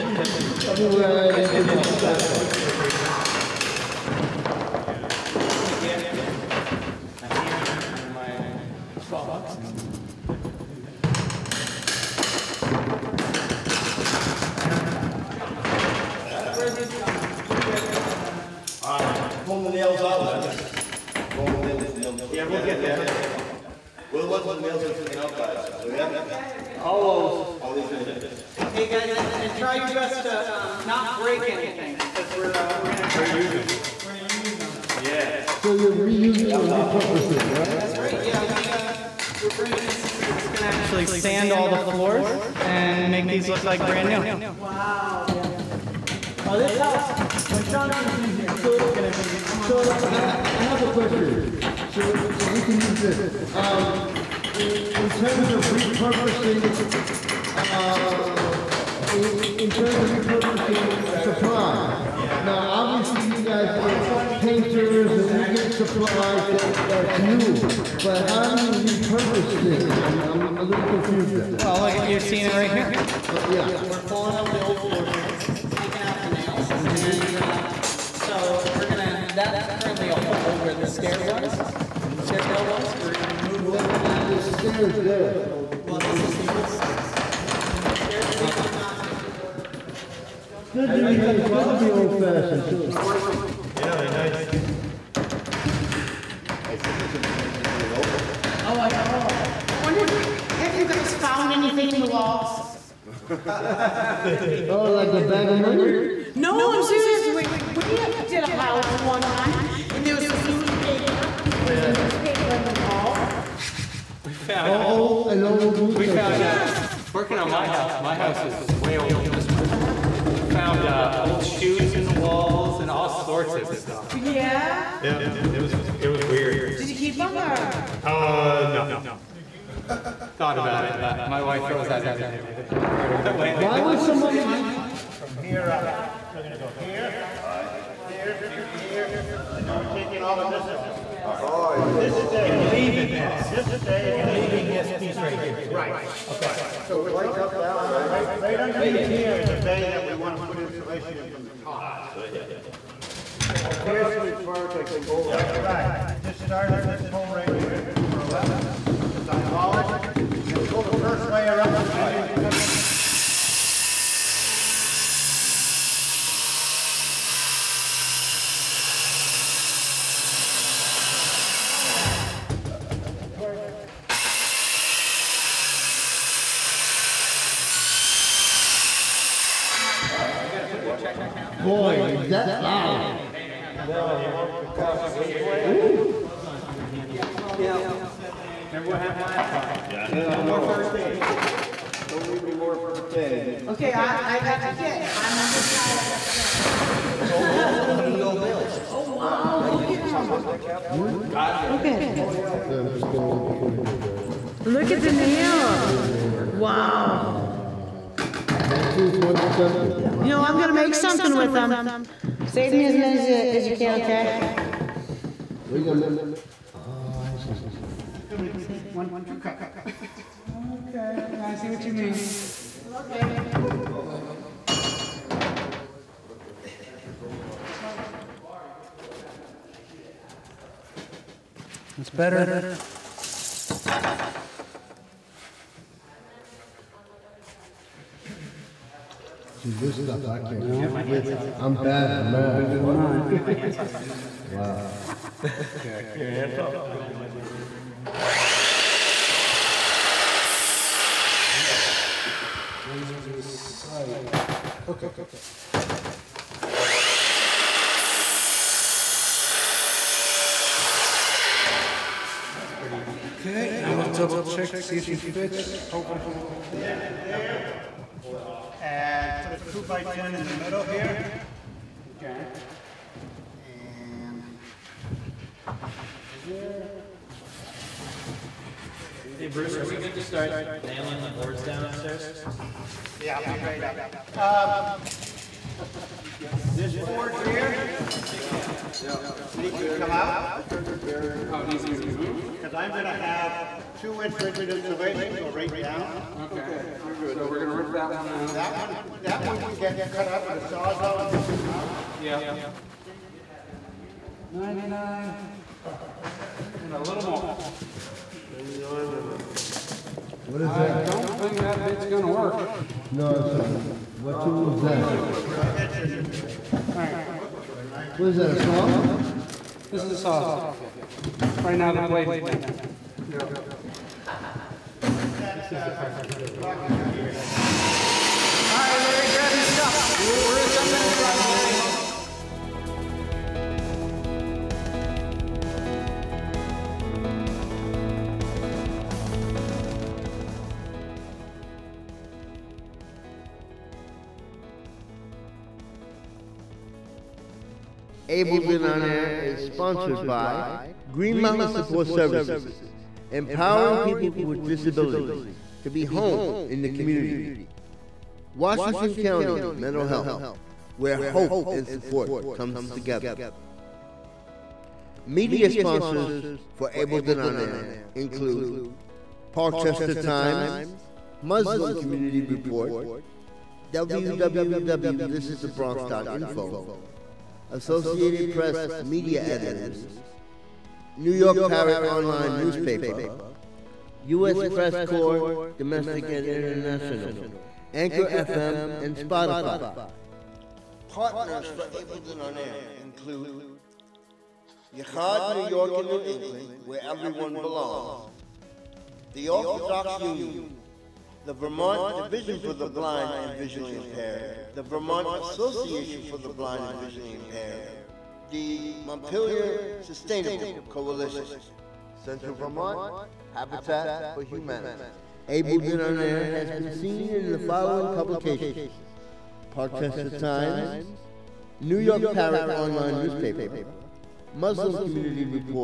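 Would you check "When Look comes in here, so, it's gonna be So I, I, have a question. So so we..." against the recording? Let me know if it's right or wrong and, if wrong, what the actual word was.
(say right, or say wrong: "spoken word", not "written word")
wrong: "Sean", not "Look".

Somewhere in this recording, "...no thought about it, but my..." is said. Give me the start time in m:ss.
2:08.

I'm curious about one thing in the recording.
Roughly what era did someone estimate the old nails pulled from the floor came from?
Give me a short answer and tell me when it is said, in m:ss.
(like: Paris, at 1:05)
1920 something, at 3:28.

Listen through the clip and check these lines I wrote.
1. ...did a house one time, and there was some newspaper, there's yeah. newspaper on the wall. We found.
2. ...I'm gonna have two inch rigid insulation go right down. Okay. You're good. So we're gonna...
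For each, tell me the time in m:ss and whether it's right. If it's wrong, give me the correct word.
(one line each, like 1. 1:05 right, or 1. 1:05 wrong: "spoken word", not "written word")
1. 1:48 right
2. 4:52 right.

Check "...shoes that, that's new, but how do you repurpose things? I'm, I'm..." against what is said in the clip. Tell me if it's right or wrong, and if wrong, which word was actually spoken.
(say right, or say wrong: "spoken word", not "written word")
wrong: "supplies", not "shoes".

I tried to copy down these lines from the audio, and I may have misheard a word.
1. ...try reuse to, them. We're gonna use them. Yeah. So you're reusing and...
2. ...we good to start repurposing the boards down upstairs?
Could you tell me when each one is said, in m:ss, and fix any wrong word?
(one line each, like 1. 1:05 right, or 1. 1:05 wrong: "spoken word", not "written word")
1. 0:33 right
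2. 4:39 wrong: "nailing", not "repurposing".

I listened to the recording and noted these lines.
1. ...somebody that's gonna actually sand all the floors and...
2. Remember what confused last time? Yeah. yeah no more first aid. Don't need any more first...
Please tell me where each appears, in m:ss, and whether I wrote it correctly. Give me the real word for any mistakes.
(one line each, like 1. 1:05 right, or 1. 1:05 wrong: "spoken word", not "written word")
1. 0:39 right
2. 3:08 wrong: "happened", not "confused".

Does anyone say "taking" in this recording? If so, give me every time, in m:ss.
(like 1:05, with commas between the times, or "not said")
1:15, 2:19.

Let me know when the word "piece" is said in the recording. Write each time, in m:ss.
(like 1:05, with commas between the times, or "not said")
2:24.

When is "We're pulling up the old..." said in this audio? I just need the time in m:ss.
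1:13.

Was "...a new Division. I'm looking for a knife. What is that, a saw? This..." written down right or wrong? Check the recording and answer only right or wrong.
wrong.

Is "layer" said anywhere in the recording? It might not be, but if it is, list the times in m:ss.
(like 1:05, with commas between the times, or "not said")
2:41.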